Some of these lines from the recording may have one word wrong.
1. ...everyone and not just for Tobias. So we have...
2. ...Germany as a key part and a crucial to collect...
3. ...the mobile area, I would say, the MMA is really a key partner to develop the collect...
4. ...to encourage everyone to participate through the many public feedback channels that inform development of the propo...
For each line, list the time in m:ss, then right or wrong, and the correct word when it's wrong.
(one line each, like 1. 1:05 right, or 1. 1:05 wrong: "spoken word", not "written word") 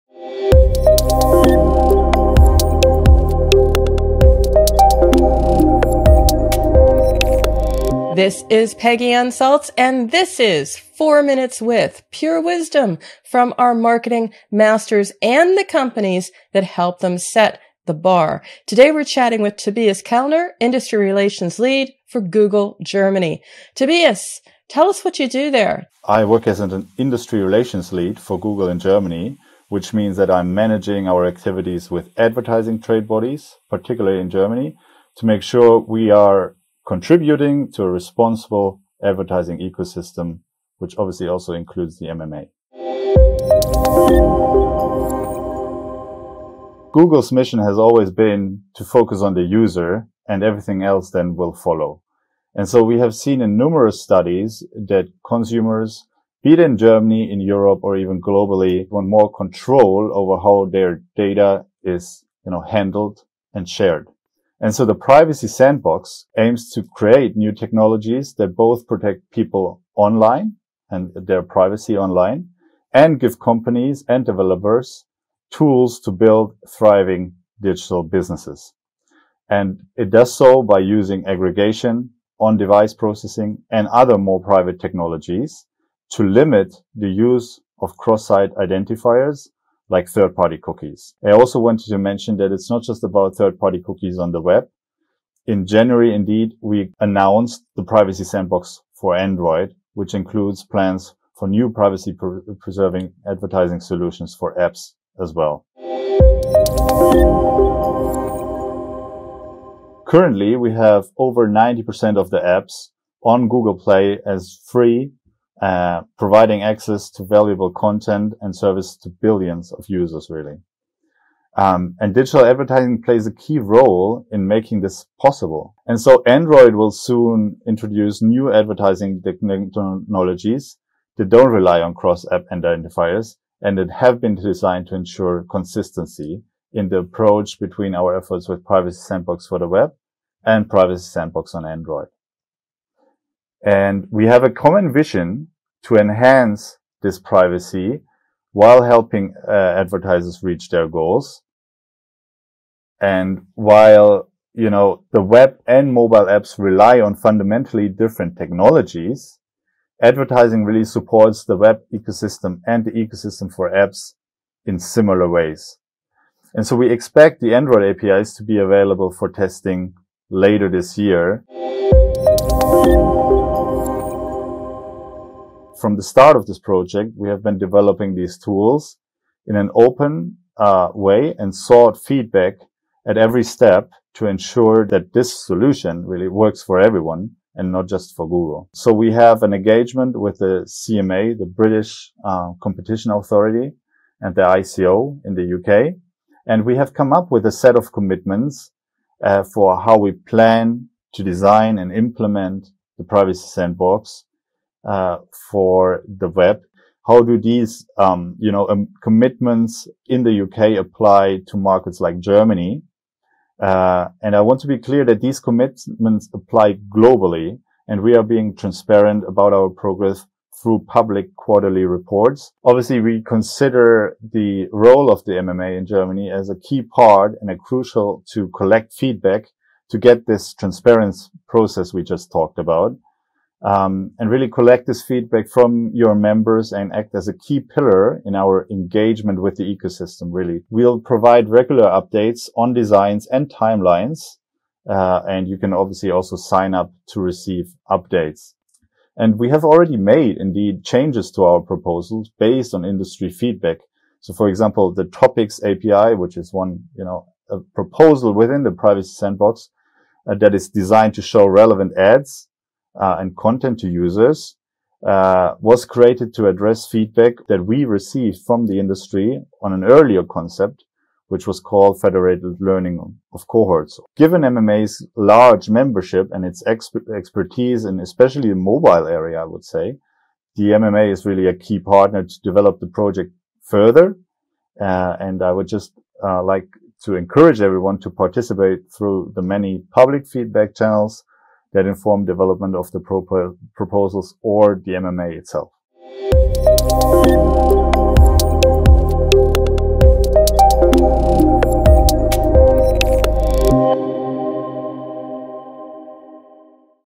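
1. 3:06 wrong: "Google", not "Tobias"
2. 3:45 right
3. 4:38 wrong: "project", not "collect"
4. 4:47 right.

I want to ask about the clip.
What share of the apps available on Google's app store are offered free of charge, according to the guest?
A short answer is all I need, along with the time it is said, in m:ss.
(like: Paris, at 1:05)
90%, at 1:51.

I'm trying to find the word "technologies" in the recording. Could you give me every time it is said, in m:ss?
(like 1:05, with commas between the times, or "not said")
1:07, 1:24, 2:09, 2:38.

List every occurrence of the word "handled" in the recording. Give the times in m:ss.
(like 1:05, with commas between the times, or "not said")
1:02.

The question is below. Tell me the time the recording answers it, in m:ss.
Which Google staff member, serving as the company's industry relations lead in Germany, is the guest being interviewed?
0:19.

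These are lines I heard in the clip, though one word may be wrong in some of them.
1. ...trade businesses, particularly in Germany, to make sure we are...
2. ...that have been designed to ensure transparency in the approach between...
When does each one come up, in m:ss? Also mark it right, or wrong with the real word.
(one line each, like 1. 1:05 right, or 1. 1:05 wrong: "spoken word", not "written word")
1. 0:32 wrong: "bodies", not "businesses"
2. 2:13 wrong: "consistency", not "transparency".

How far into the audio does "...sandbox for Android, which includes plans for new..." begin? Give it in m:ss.
1:38.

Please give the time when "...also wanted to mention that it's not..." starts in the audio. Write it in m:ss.
1:31.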